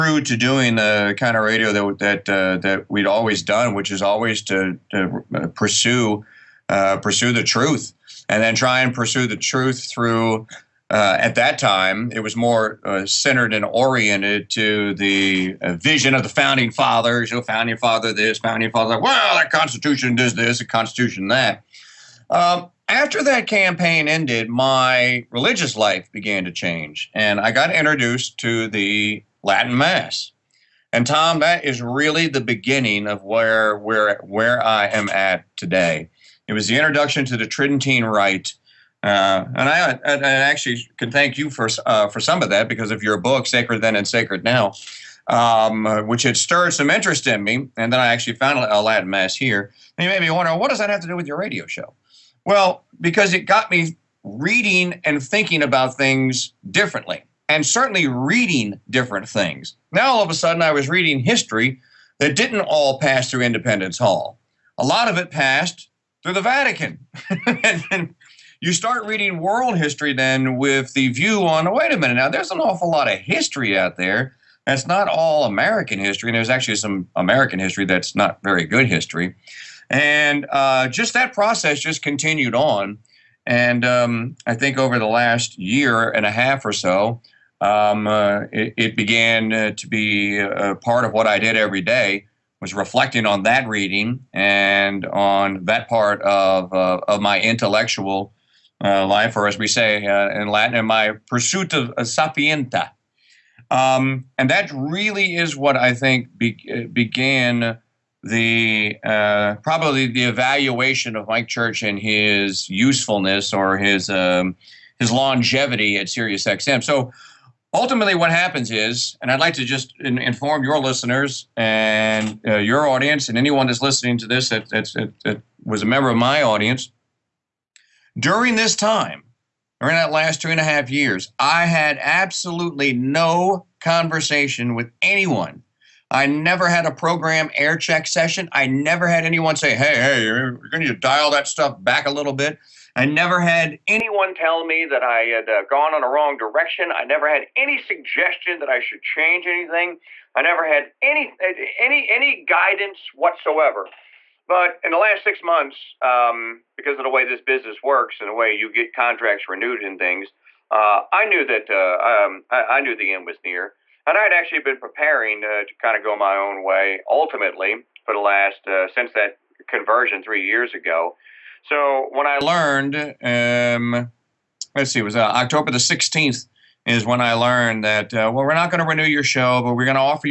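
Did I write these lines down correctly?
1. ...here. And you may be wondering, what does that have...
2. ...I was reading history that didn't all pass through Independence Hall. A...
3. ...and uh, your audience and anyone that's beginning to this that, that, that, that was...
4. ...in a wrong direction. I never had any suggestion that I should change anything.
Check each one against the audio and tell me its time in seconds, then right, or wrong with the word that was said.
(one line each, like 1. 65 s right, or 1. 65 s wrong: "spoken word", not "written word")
1. 49 s right
2. 60 s right
3. 121 s wrong: "listening", not "beginning"
4. 145 s right.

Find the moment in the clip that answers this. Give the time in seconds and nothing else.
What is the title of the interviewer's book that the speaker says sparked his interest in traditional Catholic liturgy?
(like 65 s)
43 s.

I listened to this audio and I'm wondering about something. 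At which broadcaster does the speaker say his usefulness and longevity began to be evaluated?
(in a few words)
XM.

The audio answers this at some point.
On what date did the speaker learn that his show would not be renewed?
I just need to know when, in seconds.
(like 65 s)
175 s.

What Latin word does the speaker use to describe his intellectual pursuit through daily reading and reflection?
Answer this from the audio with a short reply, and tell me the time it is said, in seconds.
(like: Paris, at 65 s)
sapientia, at 102 s.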